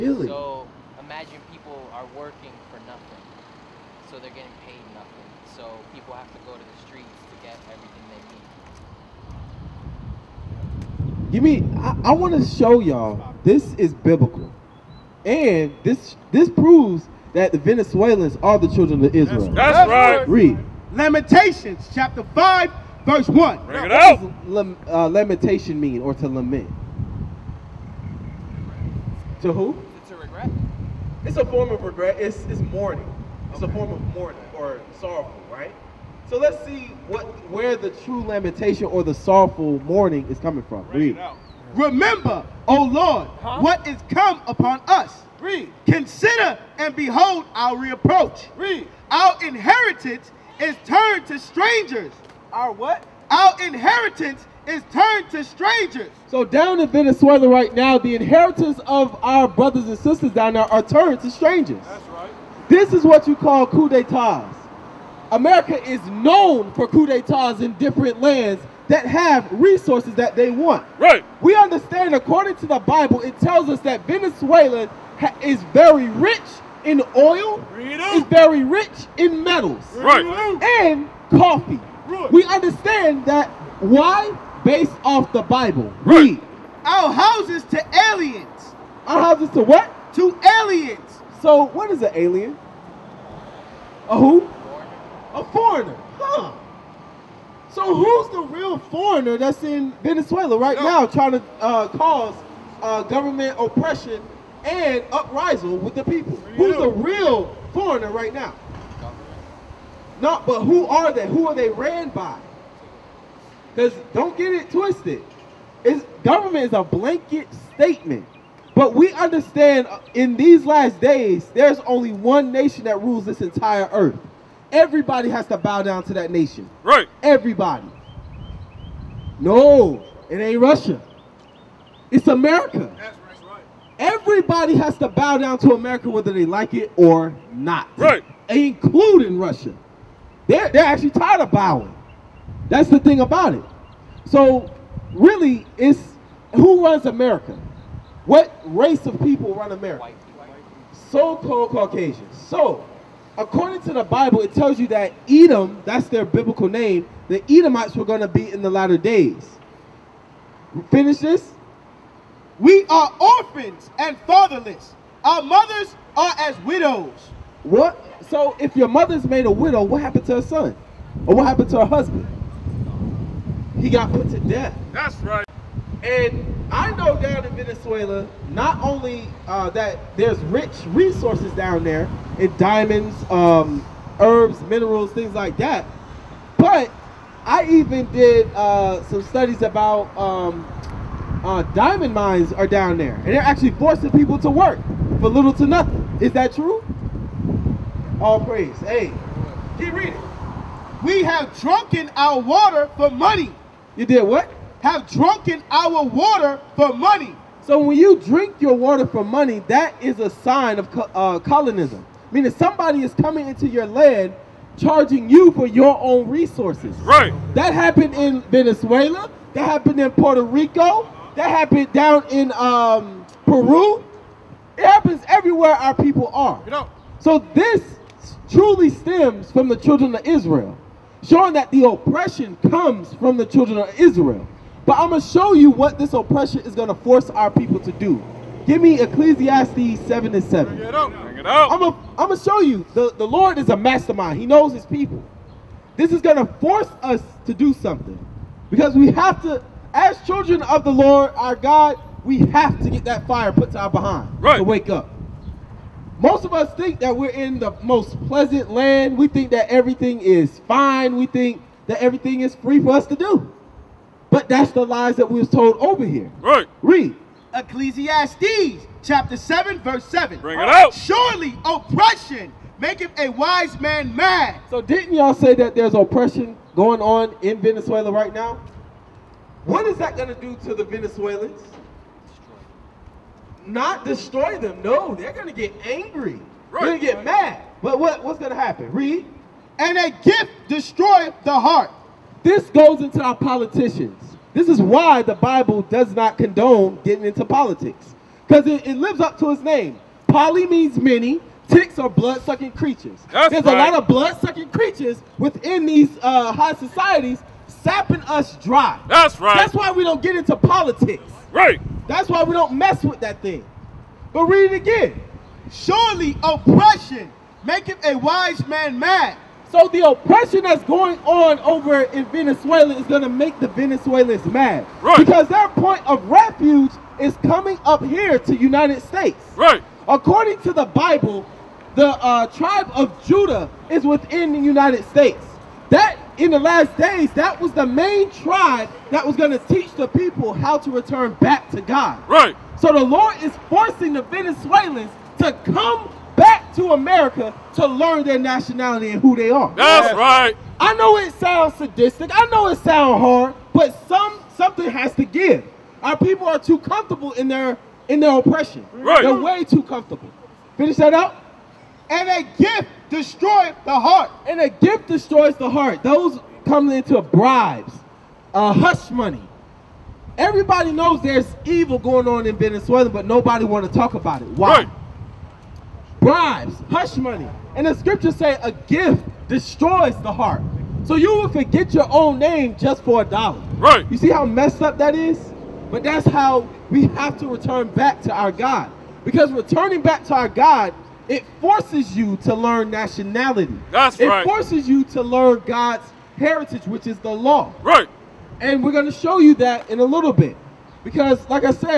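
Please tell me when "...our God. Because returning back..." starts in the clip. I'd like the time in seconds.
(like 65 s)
388 s.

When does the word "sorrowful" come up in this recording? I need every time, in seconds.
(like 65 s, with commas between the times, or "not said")
35 s, 39 s.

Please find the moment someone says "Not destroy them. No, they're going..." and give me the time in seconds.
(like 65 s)
283 s.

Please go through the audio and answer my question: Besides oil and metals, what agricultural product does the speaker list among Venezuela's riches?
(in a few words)
coffee.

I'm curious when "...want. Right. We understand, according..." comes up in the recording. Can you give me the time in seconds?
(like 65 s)
70 s.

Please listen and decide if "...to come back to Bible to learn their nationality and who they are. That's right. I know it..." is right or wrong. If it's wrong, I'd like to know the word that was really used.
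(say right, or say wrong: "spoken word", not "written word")
wrong: "America", not "Bible".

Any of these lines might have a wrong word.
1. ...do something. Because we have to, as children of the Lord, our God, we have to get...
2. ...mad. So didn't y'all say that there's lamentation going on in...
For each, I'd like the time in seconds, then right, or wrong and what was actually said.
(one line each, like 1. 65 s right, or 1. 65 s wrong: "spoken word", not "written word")
1. 247 s right
2. 274 s wrong: "oppression", not "lamentation".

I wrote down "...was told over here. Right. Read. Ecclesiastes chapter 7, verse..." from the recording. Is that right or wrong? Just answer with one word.
right.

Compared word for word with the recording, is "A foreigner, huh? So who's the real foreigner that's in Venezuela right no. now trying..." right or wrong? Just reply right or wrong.
right.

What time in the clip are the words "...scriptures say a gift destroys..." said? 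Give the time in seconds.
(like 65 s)
377 s.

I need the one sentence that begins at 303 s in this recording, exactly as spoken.
a lot of blood-sucking creatures within these uh, high societies sapping us dry.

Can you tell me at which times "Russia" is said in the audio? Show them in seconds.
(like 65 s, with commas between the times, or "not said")
130 s, 139 s.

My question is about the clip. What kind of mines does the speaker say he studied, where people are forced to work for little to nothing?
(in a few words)
diamond mines.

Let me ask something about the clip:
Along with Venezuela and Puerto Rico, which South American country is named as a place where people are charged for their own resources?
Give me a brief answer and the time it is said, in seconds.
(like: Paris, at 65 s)
Peru, at 223 s.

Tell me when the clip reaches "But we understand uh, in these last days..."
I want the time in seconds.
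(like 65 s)
118 s.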